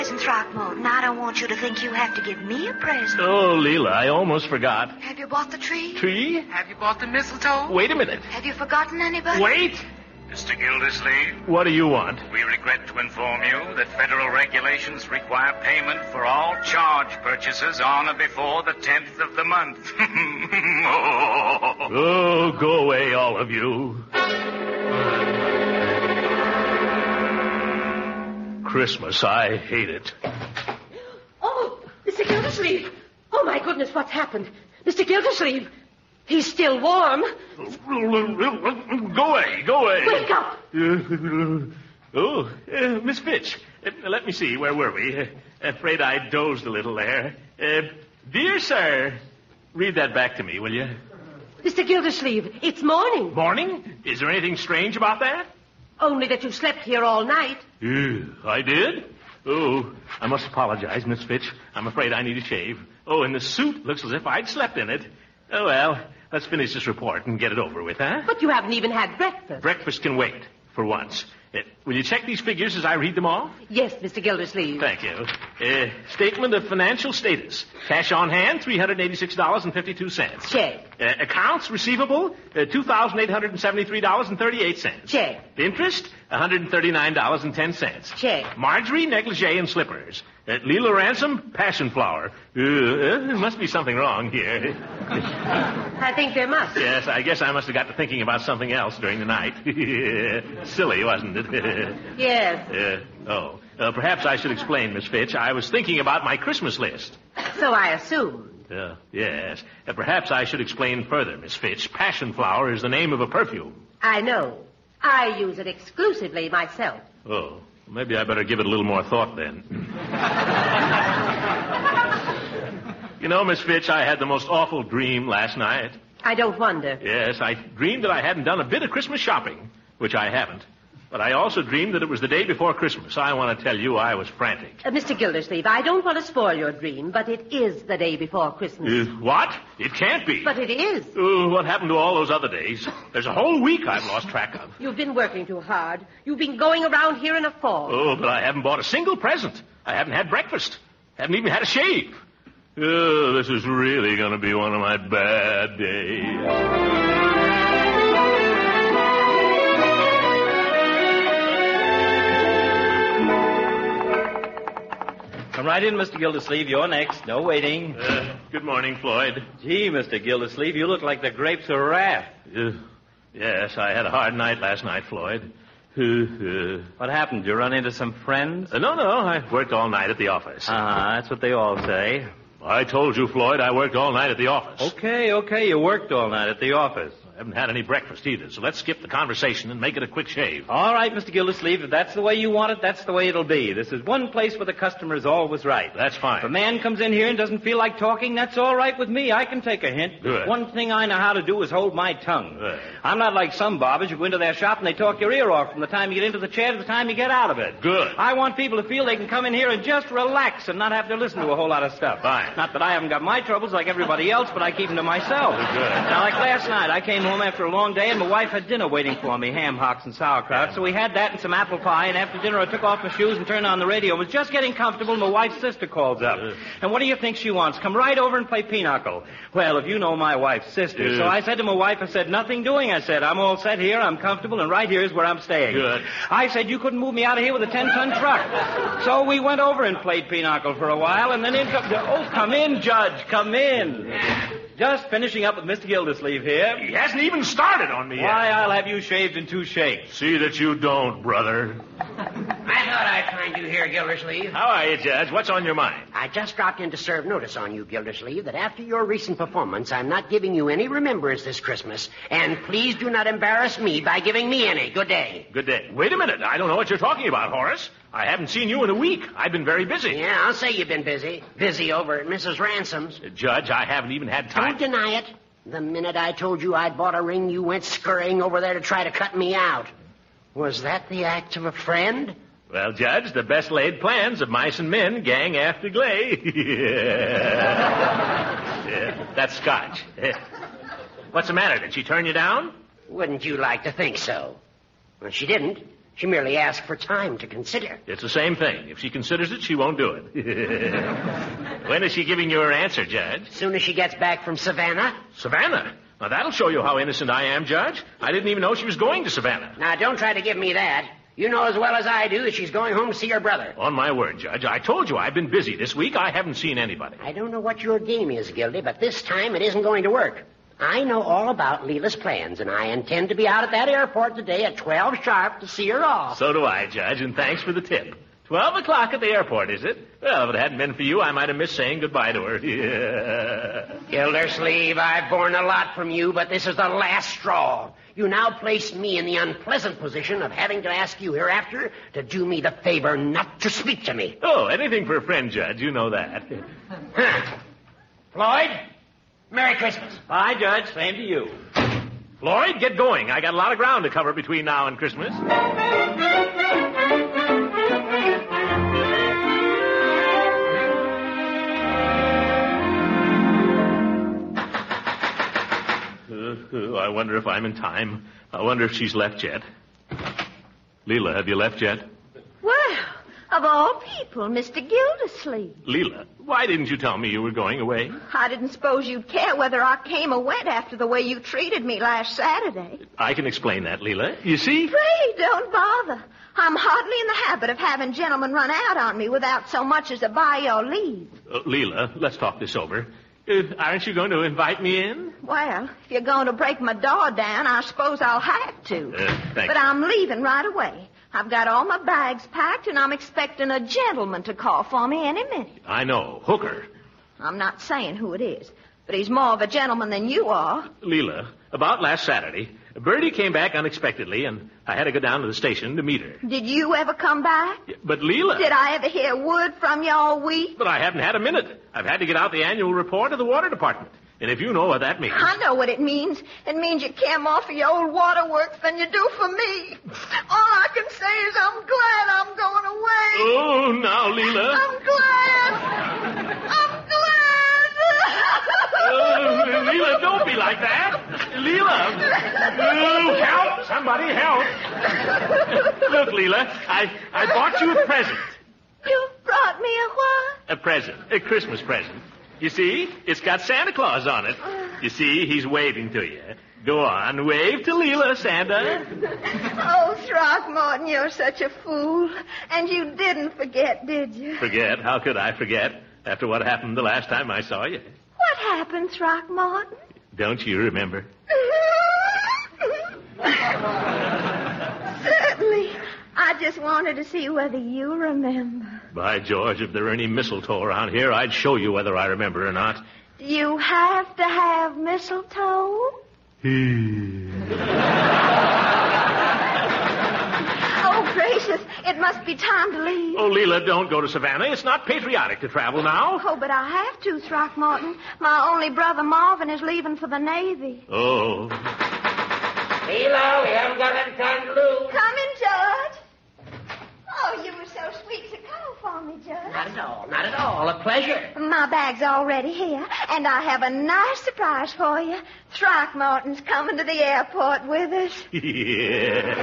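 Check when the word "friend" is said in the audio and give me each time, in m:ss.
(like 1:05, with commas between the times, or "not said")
2:58, 4:41, 5:45.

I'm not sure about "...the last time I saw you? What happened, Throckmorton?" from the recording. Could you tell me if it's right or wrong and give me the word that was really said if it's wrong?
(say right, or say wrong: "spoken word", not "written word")
right.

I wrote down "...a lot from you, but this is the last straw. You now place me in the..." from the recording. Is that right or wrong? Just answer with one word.
right.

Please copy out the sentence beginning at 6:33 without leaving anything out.
Uh, aren't you going to invite me in?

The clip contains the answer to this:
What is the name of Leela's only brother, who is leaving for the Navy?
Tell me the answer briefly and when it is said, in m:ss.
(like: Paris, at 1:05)
Marvin, at 8:19.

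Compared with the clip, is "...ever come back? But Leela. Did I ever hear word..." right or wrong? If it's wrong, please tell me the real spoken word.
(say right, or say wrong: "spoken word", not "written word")
right.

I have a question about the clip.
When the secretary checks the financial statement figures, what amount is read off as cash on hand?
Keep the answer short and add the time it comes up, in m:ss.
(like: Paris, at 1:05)
$386.52, at 1:18.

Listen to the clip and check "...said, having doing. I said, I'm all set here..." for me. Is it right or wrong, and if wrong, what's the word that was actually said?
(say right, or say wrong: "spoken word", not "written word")
wrong: "nothing", not "having".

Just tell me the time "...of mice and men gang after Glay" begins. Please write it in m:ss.
4:44.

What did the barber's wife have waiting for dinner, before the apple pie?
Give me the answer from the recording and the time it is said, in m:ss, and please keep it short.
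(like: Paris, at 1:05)
Ham hocks and sauerkraut, at 3:39.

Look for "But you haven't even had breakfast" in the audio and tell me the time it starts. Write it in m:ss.
1:08.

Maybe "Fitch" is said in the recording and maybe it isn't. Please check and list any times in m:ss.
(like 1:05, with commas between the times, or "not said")
0:43, 1:01, 1:45, 1:51, 2:03.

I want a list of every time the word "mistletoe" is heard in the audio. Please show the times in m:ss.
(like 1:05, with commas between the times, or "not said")
0:07, 8:00, 8:04.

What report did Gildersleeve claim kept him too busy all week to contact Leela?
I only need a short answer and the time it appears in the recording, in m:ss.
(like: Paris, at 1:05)
Annual report of the water department, at 7:02.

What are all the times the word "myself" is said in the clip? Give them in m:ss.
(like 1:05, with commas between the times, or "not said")
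1:56, 3:35.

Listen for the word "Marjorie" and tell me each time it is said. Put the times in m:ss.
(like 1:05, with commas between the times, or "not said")
1:28.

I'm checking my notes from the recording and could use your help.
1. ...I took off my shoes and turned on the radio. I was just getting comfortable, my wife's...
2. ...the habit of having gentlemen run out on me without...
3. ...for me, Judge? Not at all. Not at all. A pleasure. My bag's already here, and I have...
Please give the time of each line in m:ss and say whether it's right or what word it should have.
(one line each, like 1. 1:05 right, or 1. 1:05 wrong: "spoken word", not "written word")
1. 3:42 right
2. 6:27 right
3. 8:29 right.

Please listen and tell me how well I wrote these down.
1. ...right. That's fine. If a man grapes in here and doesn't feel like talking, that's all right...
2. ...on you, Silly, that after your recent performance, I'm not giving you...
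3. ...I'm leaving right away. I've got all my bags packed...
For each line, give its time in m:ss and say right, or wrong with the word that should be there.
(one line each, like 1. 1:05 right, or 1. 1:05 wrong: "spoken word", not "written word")
1. 3:15 wrong: "comes", not "grapes"
2. 4:17 wrong: "Gildersleeve", not "Silly"
3. 6:39 right.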